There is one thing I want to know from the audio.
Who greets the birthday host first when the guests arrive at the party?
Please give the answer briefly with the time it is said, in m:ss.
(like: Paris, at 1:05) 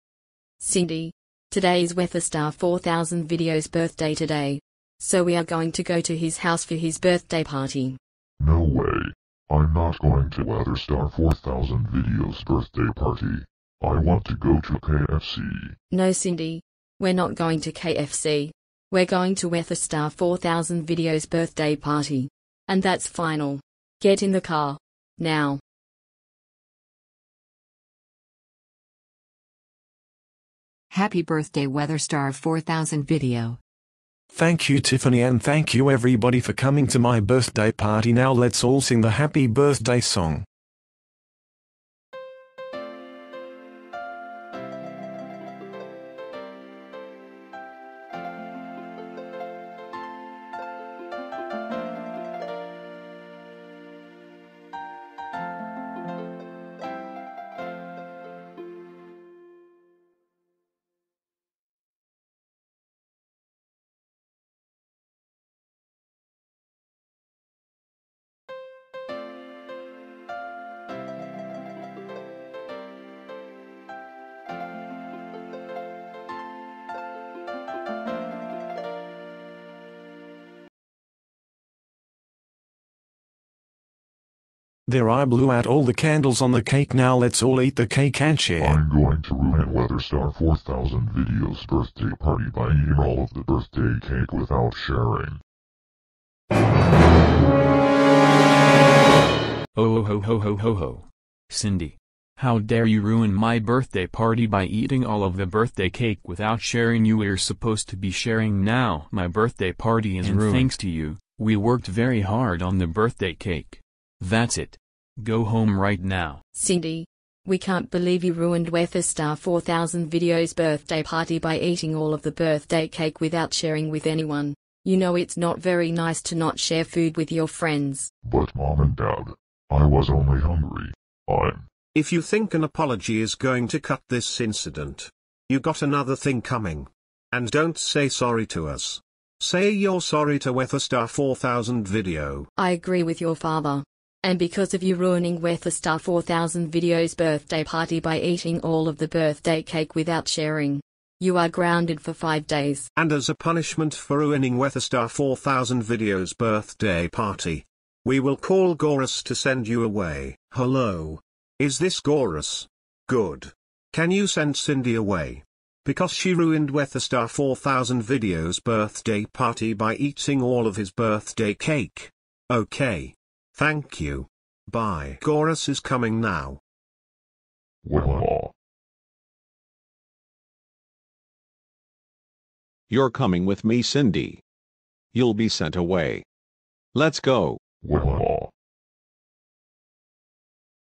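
Tiffany, at 0:34.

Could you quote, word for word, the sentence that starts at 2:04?
You know it's not very nice to not share food with your friends.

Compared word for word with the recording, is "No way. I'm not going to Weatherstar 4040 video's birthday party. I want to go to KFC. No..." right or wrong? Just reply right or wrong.
wrong.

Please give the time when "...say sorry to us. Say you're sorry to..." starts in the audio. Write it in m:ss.
2:17.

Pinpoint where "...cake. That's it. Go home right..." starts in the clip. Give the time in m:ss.
1:53.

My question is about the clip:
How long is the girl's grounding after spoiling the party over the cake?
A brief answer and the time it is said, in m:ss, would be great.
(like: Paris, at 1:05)
5 days, at 2:32.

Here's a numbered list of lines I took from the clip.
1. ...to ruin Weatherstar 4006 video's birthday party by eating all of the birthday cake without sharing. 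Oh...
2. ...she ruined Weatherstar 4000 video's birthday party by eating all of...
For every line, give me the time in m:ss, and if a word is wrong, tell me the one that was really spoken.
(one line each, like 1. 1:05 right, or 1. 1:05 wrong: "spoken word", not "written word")
1. 1:29 wrong: "4000", not "4006"
2. 2:46 right.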